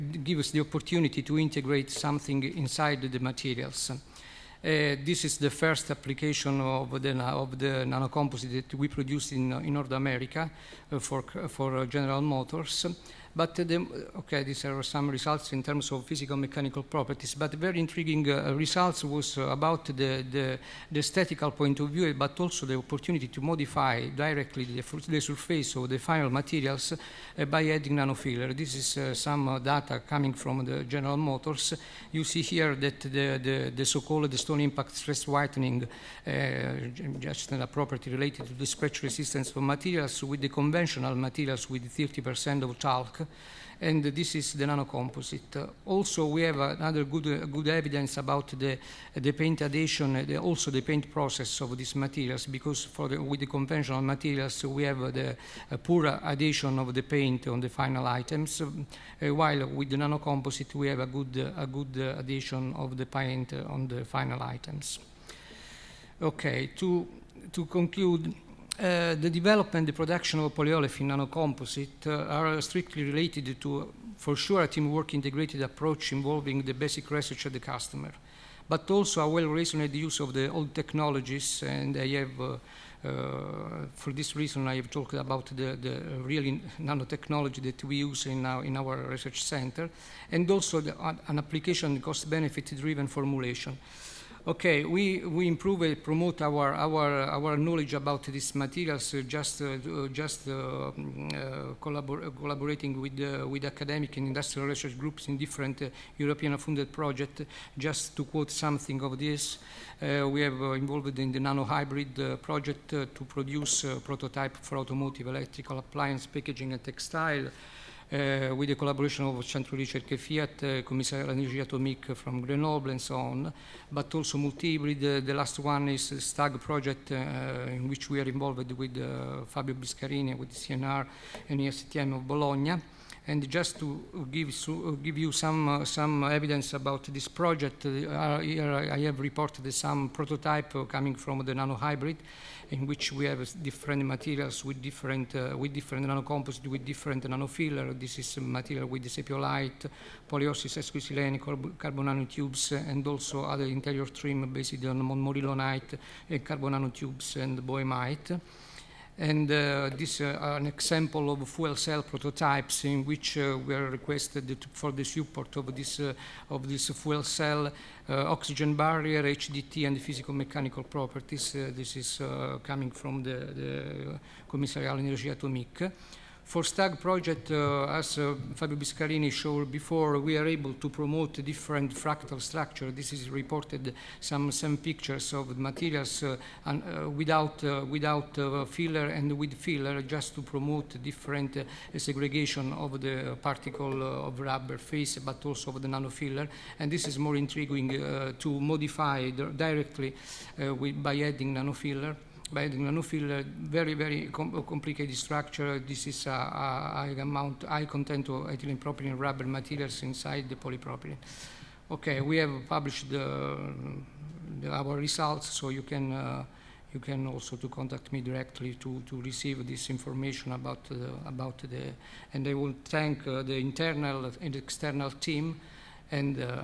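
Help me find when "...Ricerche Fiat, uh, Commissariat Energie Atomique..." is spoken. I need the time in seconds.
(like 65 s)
119 s.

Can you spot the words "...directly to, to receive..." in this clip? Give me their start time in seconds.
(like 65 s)
218 s.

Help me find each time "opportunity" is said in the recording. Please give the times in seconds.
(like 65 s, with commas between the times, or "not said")
0 s, 22 s.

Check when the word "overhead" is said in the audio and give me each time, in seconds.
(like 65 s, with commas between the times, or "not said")
not said.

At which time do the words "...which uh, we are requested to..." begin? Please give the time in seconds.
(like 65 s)
163 s.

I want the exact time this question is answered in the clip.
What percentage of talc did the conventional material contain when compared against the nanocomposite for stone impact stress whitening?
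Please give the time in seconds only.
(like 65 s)
41 s.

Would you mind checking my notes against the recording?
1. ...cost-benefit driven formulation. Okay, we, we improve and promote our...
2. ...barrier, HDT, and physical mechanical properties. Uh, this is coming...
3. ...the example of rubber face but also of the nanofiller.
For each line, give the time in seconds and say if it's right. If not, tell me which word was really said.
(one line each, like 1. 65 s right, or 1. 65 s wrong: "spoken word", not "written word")
1. 92 s right
2. 168 s right
3. 193 s wrong: "particle", not "example".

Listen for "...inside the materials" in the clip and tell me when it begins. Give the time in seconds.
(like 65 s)
2 s.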